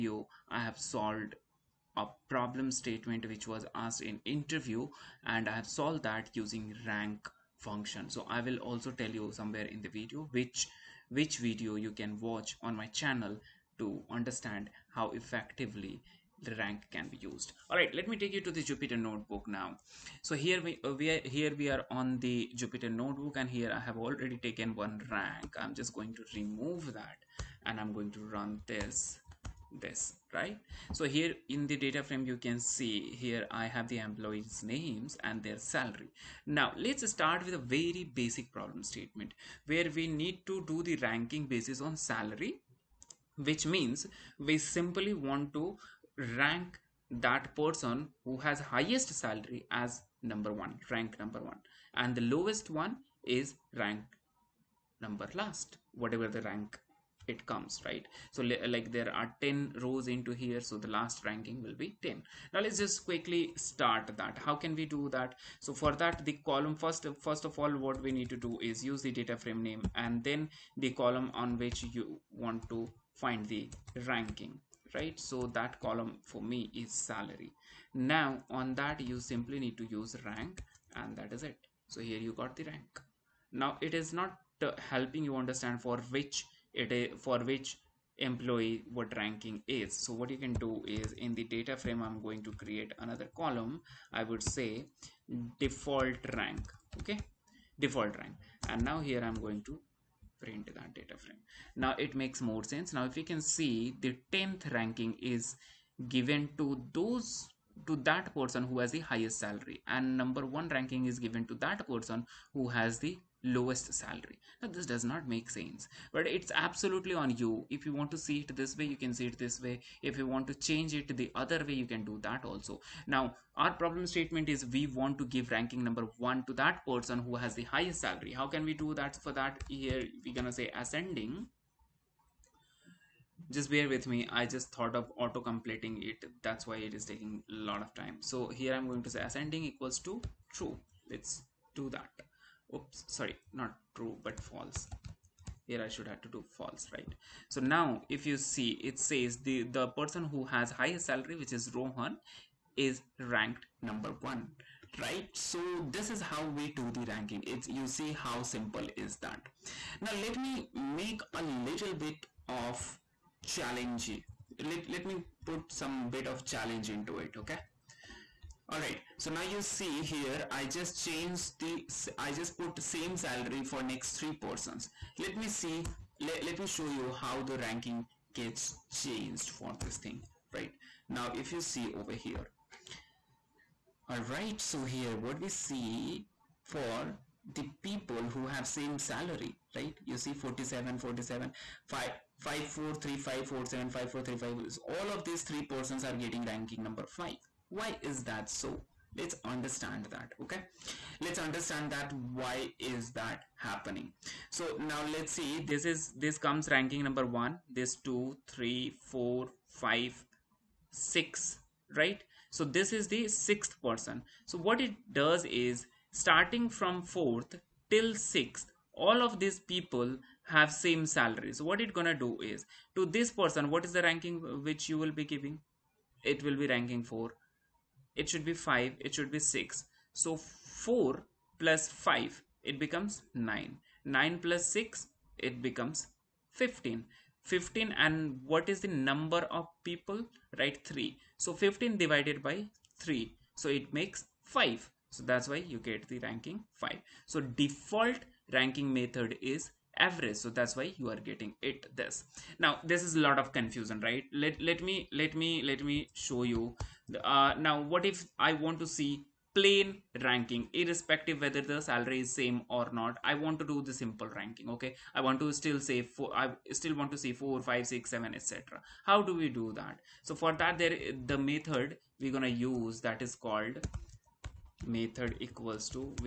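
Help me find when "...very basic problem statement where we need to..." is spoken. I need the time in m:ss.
0:37.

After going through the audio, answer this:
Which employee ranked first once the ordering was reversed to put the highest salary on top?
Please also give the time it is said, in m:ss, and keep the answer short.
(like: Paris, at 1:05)
Rohan, at 2:31.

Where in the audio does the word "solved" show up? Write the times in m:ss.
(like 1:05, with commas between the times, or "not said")
0:00, 0:05.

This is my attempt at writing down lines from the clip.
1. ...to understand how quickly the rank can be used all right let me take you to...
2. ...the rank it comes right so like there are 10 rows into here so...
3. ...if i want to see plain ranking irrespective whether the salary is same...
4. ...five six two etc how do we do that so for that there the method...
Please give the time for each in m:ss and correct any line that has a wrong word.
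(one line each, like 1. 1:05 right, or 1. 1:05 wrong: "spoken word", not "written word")
1. 0:13 wrong: "effectively", not "quickly"
2. 0:56 right
3. 4:18 right
4. 4:27 wrong: "seven", not "two".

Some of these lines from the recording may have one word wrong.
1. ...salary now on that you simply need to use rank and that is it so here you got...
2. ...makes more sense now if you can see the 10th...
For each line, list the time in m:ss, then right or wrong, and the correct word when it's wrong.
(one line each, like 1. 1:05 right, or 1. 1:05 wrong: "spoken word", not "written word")
1. 1:16 right
2. 1:42 right.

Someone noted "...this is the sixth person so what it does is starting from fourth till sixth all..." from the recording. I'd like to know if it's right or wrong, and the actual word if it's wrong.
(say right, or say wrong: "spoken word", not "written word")
right.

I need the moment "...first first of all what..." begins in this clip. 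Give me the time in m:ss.
1:06.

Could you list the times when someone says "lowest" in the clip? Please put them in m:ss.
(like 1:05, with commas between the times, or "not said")
0:52, 1:53.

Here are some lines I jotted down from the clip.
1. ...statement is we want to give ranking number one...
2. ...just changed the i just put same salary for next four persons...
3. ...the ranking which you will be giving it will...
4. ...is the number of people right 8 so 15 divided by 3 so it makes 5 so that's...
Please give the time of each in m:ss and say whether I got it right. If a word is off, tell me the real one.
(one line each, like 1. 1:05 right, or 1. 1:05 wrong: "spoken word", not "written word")
1. 2:04 right
2. 2:50 wrong: "three", not "four"
3. 3:43 right
4. 3:58 wrong: "3", not "8".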